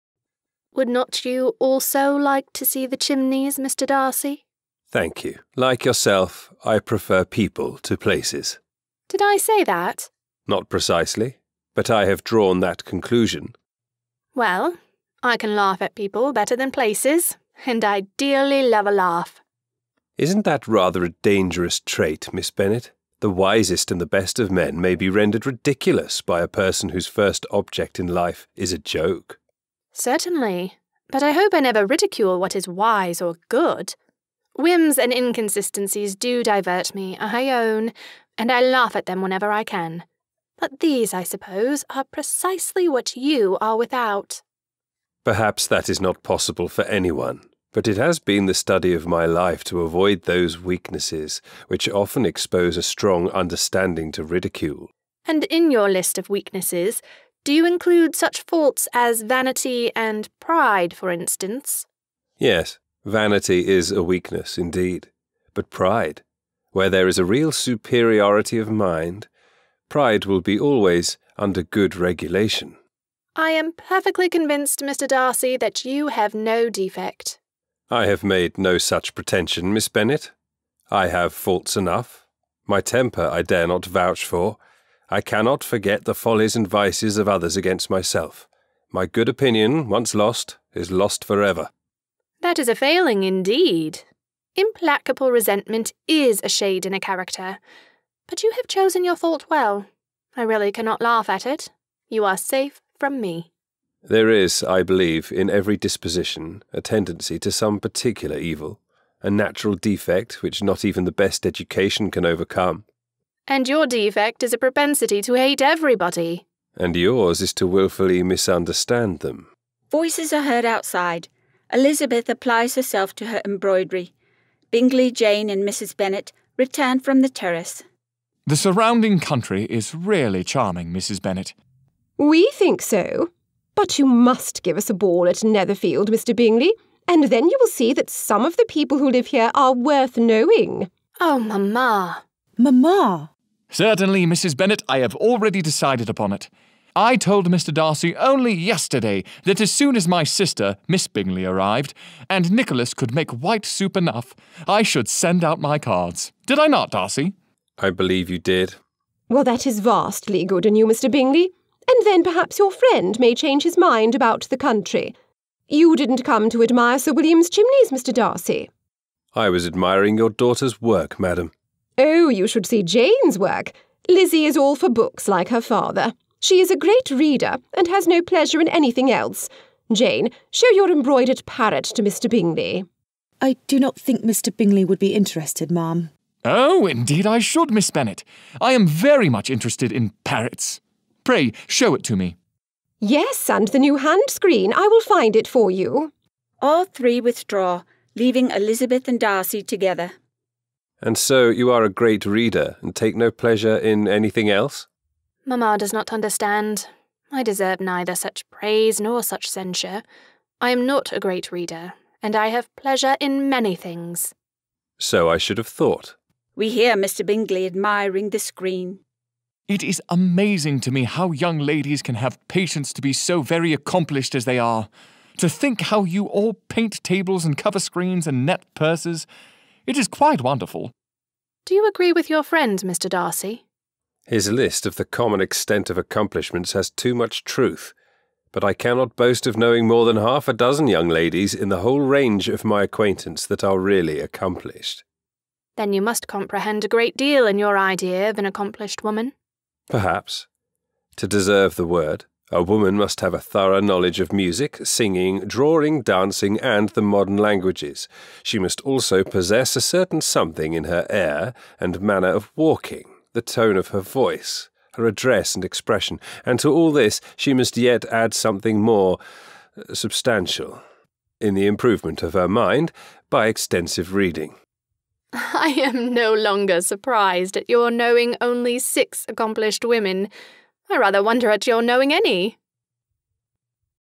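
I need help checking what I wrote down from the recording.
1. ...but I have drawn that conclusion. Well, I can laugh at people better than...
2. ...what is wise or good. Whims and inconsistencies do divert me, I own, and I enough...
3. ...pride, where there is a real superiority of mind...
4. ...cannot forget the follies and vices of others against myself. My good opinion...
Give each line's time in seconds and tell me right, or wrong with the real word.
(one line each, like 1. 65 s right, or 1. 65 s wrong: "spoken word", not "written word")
1. 11 s right
2. 32 s wrong: "laugh", not "enough"
3. 65 s right
4. 85 s right.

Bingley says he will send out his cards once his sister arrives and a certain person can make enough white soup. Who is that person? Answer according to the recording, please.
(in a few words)
Nicholas.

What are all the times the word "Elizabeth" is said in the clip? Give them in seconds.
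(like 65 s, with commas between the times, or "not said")
121 s, 198 s.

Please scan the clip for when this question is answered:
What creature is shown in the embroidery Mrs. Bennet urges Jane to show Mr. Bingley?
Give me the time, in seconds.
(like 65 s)
181 s.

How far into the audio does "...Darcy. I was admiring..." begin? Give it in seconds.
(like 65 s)
168 s.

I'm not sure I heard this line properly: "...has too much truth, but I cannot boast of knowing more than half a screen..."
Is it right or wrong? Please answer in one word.
wrong.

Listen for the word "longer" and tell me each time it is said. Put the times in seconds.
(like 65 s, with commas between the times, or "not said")
276 s.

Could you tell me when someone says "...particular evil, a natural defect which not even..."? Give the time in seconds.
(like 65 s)
107 s.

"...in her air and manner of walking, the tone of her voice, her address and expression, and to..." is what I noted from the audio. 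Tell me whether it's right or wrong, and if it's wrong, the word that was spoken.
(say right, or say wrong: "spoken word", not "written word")
right.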